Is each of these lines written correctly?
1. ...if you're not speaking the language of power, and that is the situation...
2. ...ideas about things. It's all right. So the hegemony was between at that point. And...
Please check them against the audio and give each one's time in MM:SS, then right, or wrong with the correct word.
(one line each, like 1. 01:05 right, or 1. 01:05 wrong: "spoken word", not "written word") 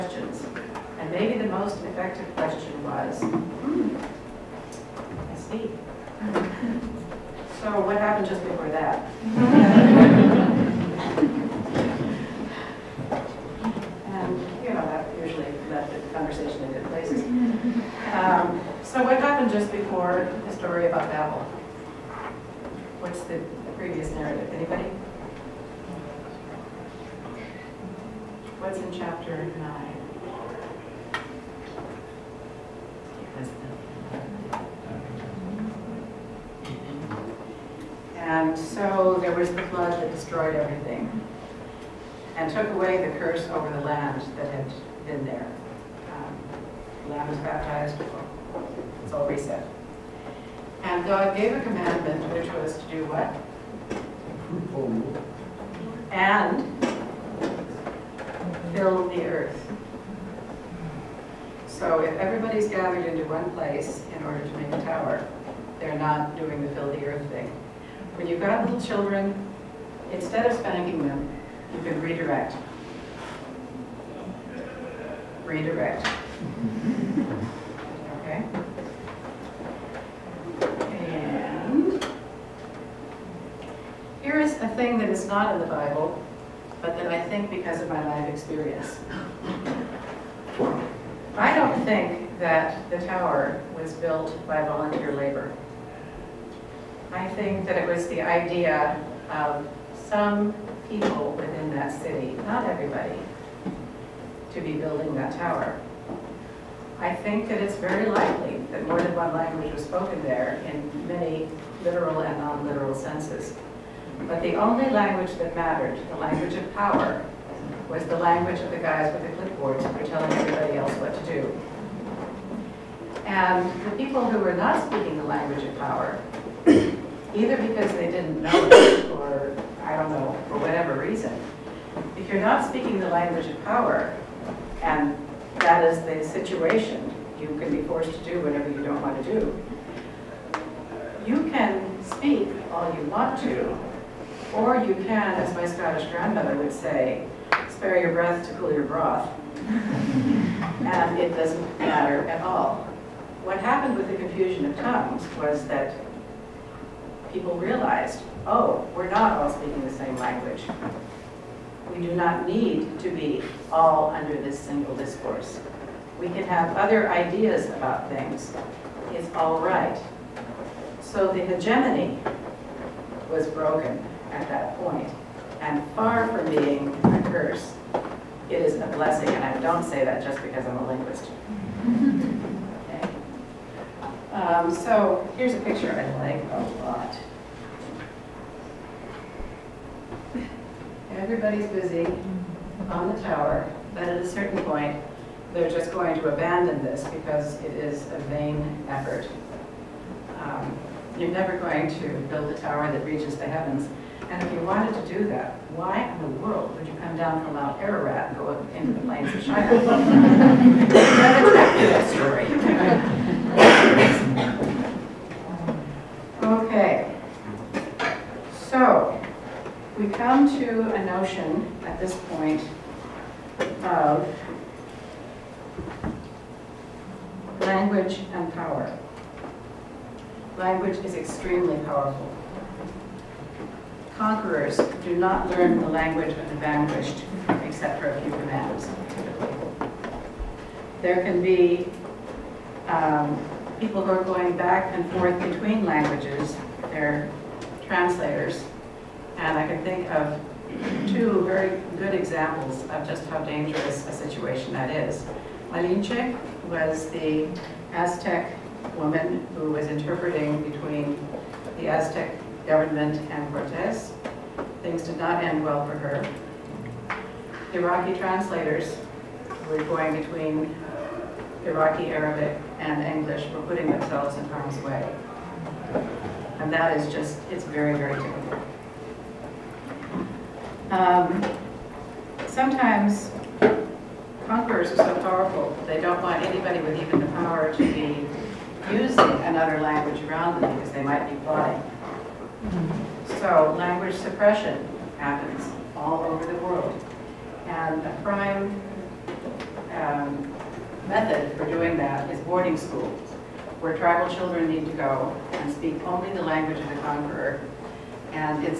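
1. 02:12 right
2. 02:47 wrong: "broken", not "between".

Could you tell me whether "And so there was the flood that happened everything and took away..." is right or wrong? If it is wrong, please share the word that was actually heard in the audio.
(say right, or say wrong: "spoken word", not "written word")
wrong: "destroyed", not "happened".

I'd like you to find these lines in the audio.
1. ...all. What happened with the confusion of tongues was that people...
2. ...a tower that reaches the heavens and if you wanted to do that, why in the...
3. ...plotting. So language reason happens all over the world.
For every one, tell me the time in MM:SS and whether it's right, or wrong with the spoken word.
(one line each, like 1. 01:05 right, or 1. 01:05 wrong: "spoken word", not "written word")
1. 02:32 right
2. 03:22 right
3. 04:51 wrong: "suppression", not "reason".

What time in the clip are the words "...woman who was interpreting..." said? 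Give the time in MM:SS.
04:18.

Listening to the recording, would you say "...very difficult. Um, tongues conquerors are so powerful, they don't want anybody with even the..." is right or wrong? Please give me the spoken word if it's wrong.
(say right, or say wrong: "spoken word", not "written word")
wrong: "sometimes", not "tongues".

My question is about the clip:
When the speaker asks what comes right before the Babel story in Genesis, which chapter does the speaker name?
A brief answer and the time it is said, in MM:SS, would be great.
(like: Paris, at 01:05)
Chapter 9, at 00:28.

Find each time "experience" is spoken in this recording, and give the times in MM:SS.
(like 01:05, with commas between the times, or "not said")
01:28.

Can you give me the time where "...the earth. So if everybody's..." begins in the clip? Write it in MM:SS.
00:59.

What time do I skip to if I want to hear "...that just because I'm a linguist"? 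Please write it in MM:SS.
03:00.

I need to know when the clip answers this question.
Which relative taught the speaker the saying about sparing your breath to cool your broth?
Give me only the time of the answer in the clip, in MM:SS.
02:25.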